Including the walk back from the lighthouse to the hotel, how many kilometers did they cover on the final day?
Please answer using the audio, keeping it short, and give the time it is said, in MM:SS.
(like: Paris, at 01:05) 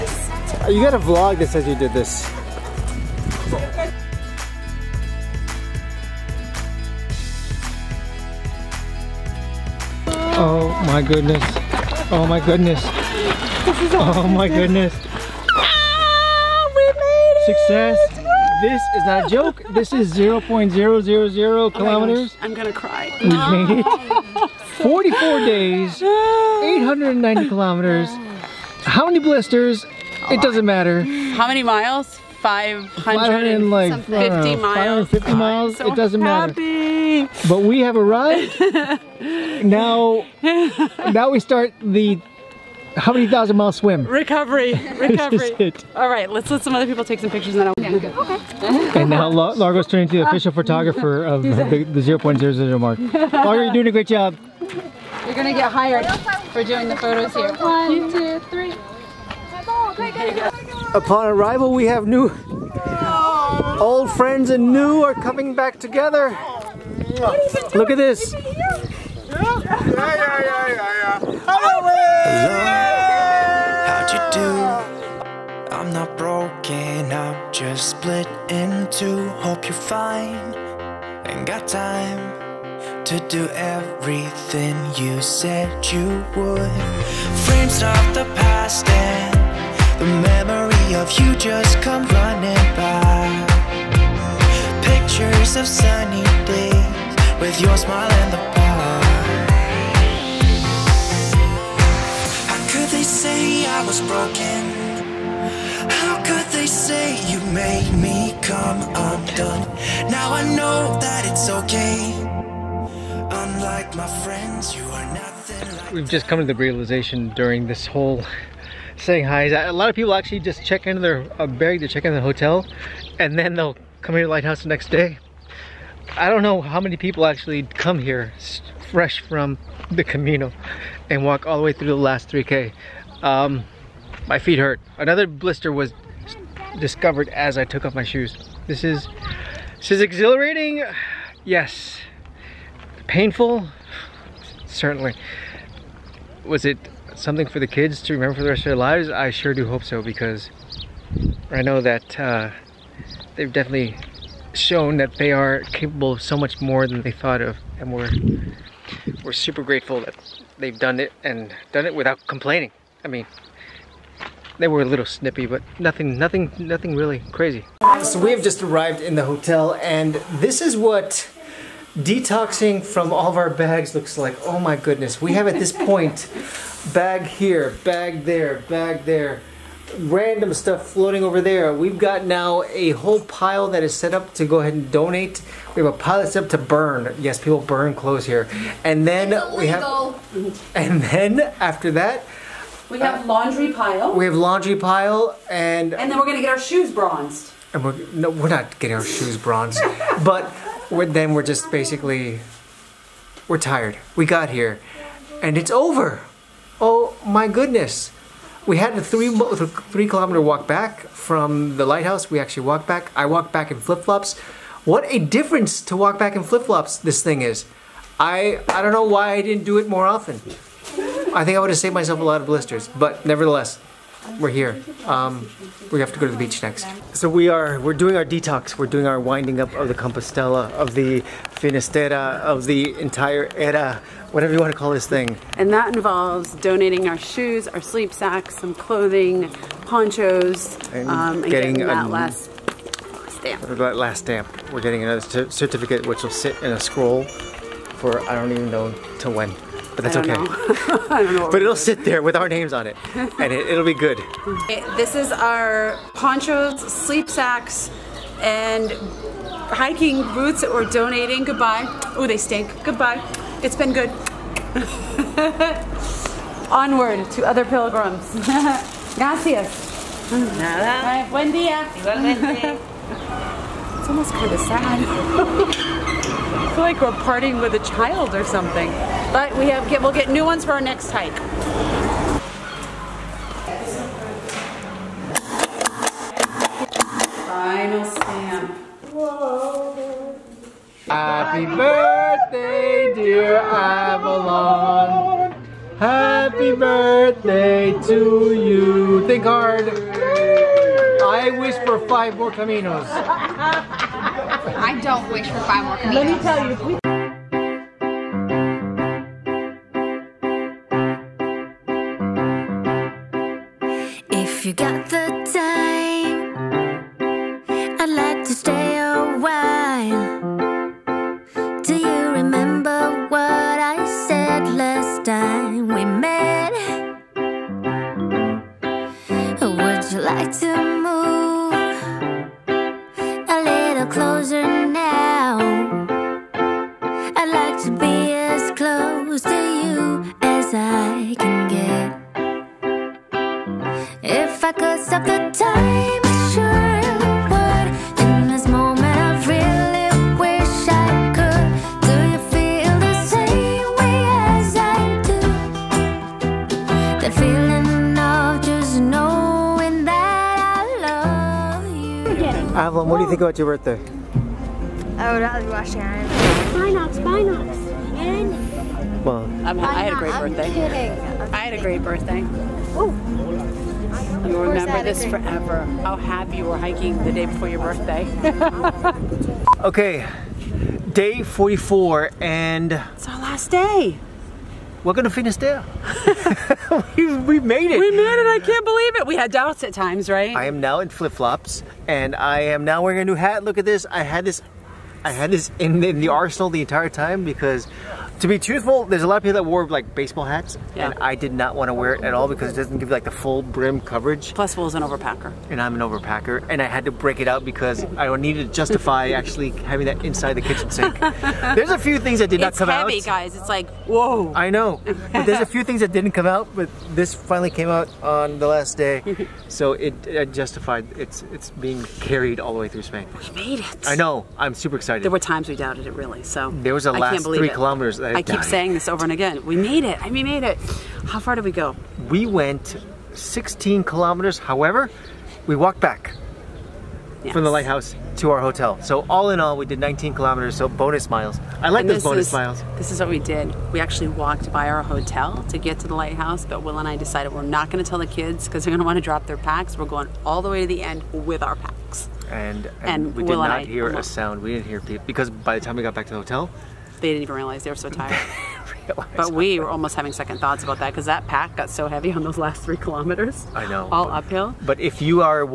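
19 kilometers, at 07:19.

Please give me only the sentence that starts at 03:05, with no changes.
We have a pile that's set up to burn.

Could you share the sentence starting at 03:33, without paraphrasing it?
I walked back in flip flops.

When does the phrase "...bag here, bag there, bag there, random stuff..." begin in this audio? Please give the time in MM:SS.
02:56.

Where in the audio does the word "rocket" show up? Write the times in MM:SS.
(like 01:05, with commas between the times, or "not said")
not said.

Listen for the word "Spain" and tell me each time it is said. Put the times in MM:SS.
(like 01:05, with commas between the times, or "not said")
07:03.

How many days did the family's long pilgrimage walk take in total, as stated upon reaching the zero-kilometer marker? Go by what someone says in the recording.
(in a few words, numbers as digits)
44 days.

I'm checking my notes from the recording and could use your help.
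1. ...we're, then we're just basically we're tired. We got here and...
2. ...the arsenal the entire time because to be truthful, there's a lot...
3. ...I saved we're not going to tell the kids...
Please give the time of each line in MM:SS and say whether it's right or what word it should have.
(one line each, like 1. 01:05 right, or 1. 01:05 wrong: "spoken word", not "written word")
1. 03:20 right
2. 06:36 right
3. 07:27 wrong: "decided", not "saved".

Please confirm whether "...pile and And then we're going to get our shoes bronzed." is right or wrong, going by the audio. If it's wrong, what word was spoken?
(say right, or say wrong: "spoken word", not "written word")
right.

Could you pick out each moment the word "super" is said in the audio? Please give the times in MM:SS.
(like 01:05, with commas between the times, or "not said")
02:39, 07:04.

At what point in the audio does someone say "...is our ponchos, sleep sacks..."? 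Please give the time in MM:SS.
04:15.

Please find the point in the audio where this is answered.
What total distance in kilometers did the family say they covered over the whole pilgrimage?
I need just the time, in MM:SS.
00:26.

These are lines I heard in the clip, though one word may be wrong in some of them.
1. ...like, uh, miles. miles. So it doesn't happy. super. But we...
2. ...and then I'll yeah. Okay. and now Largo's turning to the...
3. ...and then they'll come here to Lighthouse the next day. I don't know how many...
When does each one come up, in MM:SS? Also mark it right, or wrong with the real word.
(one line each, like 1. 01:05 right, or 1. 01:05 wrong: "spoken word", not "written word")
1. 00:33 wrong: "matter", not "super"
2. 00:47 right
3. 02:03 right.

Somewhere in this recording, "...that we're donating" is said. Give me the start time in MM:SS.
04:20.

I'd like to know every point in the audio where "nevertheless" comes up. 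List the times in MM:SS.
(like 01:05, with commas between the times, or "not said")
03:43.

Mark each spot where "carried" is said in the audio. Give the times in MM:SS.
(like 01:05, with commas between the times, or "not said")
07:02.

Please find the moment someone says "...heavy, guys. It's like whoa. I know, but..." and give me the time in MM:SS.
06:53.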